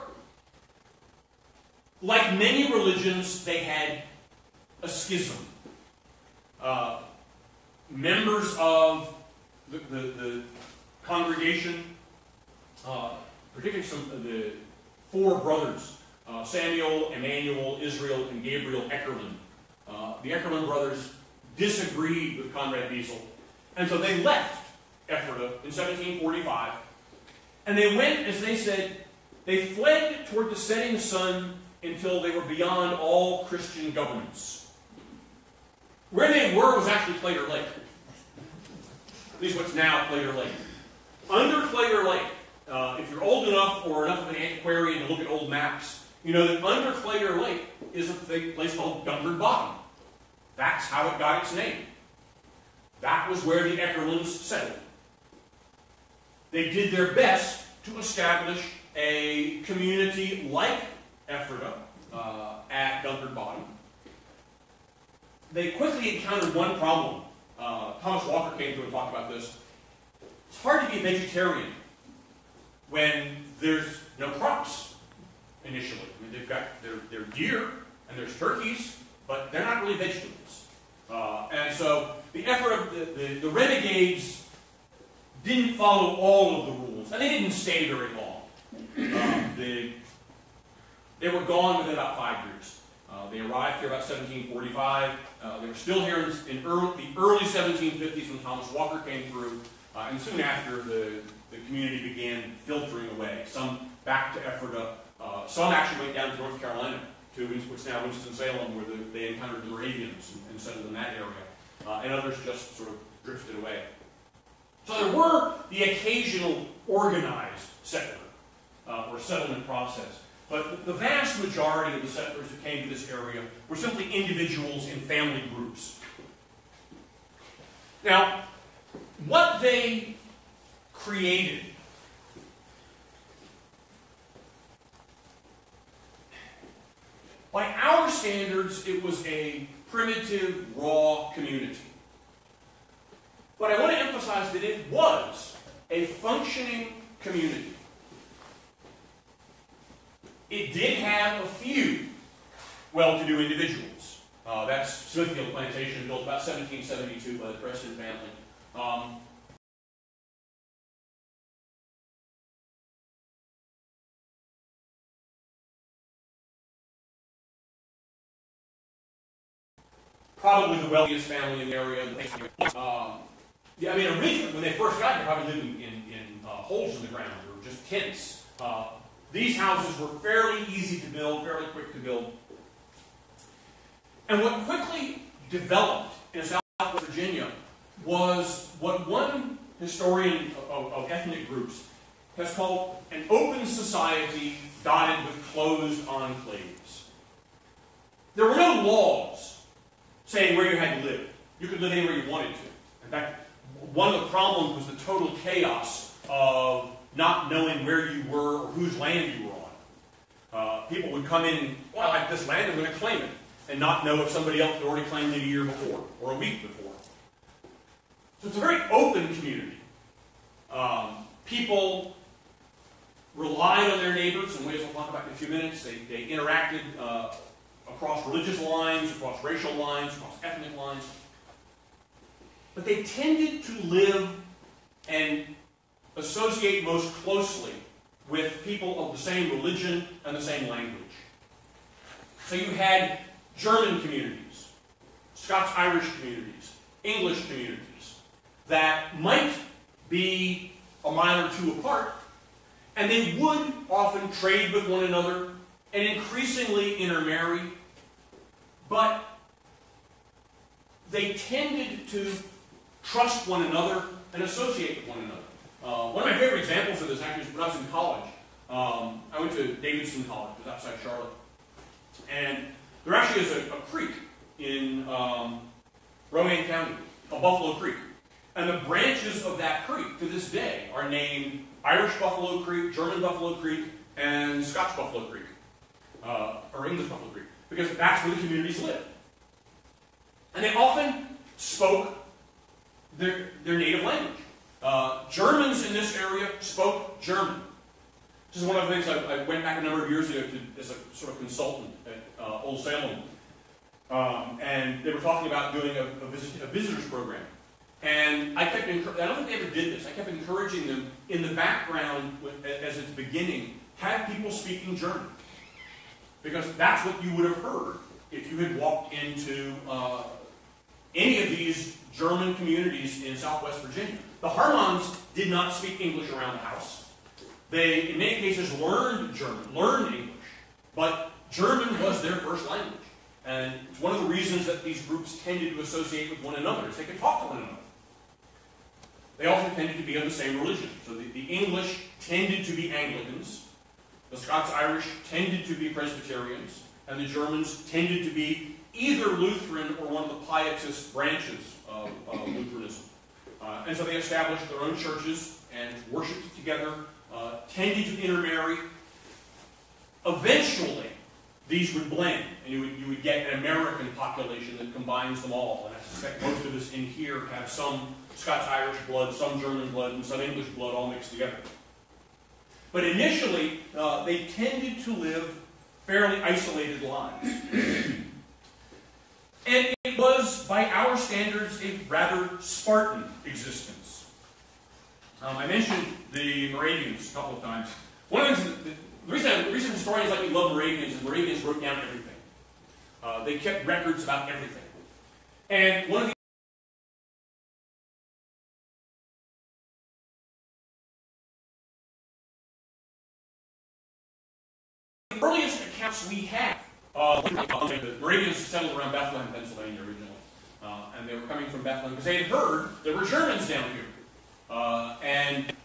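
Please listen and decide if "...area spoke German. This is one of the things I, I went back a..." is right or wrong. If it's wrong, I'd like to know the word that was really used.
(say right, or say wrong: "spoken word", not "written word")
right.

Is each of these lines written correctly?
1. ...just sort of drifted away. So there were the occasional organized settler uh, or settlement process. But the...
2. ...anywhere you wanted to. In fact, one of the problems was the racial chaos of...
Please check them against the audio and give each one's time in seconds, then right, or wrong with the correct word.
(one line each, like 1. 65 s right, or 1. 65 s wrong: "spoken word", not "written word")
1. 112 s right
2. 201 s wrong: "total", not "racial".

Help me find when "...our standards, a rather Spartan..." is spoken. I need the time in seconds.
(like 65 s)
380 s.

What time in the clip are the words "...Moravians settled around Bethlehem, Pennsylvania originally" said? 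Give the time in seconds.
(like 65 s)
408 s.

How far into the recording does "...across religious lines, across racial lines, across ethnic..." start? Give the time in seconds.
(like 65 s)
227 s.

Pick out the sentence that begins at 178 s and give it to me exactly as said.
Uh, these houses were fairly easy to build, fairly quick to build.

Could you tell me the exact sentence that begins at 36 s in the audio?
Where they were was actually Claytor Lake.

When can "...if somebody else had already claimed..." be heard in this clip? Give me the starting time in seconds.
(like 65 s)
214 s.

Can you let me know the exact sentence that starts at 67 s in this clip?
Uh, Thomas Walker came through and talked about this.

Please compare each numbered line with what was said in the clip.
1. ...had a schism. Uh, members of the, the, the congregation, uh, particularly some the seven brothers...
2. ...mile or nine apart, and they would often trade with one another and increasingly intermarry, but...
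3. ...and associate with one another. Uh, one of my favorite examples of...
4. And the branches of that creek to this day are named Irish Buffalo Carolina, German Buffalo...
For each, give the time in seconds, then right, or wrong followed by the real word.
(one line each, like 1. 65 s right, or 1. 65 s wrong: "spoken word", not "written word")
1. 3 s wrong: "four", not "seven"
2. 251 s wrong: "two", not "nine"
3. 264 s right
4. 278 s wrong: "Creek", not "Carolina".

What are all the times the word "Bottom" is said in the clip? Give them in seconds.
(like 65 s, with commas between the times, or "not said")
49 s, 63 s.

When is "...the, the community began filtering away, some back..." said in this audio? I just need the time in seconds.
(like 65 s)
100 s.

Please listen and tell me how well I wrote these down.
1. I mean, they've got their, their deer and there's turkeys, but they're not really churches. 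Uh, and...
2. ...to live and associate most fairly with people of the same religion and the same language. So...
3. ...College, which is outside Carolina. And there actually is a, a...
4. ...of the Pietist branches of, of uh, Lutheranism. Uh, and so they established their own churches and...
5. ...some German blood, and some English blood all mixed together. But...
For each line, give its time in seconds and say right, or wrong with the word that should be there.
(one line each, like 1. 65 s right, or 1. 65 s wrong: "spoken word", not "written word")
1. 76 s wrong: "vegetables", not "churches"
2. 233 s wrong: "closely", not "fairly"
3. 270 s wrong: "Charlotte", not "Carolina"
4. 350 s right
5. 369 s right.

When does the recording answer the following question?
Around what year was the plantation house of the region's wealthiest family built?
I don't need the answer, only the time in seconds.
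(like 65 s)
156 s.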